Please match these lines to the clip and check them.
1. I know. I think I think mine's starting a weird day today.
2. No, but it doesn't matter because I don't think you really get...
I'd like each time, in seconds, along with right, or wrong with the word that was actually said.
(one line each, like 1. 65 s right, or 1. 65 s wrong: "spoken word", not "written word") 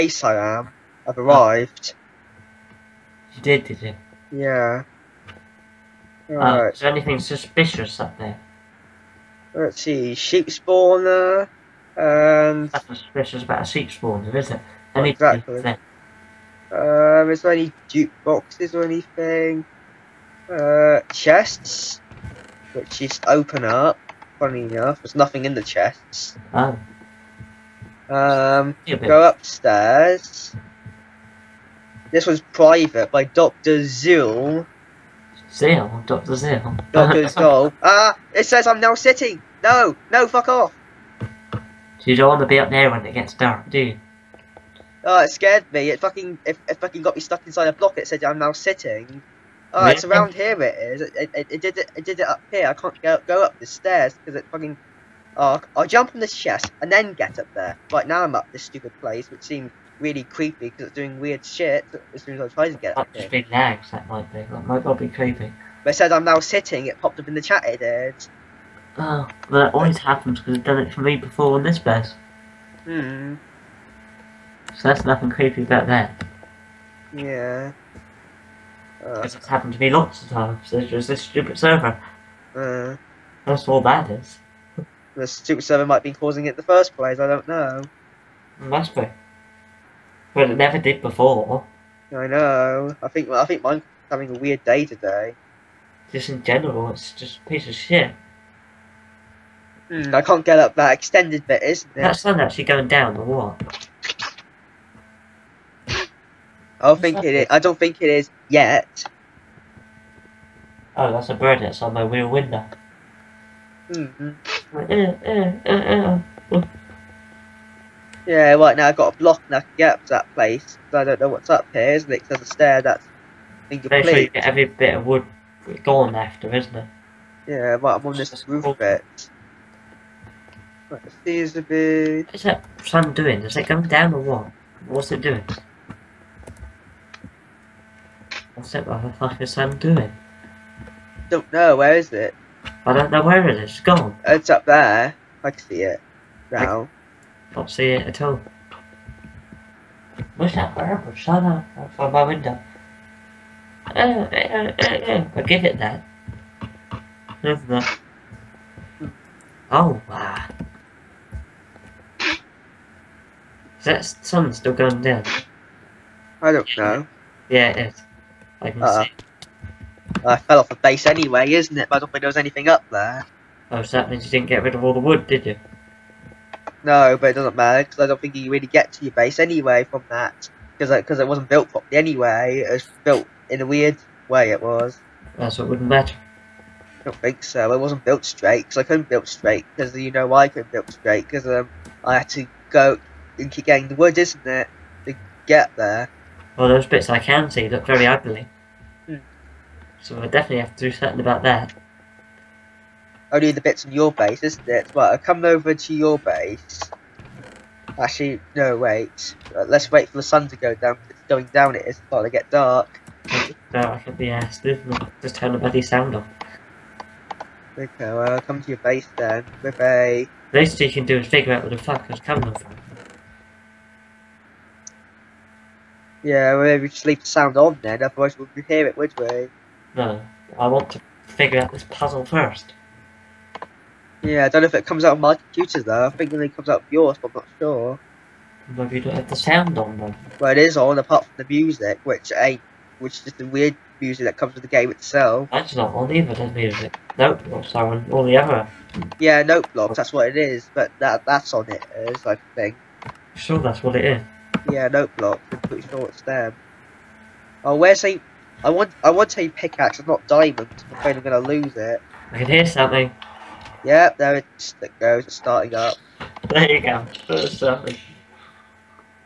1. 92 s wrong: "having", not "starting"
2. 176 s right.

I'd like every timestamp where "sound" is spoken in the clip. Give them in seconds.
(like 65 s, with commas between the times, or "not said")
215 s, 227 s, 239 s.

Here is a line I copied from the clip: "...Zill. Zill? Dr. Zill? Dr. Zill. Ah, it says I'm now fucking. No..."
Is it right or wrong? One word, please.
wrong.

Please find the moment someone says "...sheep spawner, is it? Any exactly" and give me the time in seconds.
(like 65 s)
13 s.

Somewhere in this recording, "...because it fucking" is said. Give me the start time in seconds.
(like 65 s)
54 s.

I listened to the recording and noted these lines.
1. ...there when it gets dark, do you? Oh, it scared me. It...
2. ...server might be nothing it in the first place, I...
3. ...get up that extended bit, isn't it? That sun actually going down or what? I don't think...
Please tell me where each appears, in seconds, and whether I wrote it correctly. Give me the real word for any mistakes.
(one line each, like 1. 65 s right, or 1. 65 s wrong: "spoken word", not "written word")
1. 42 s right
2. 85 s wrong: "causing", not "nothing"
3. 100 s right.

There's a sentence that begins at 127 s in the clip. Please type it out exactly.
Yeah, right, I'm on this That's roof cool.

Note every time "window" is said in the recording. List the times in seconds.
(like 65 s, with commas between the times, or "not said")
112 s, 152 s.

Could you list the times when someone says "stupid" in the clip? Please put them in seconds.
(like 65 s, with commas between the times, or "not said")
58 s, 81 s, 85 s.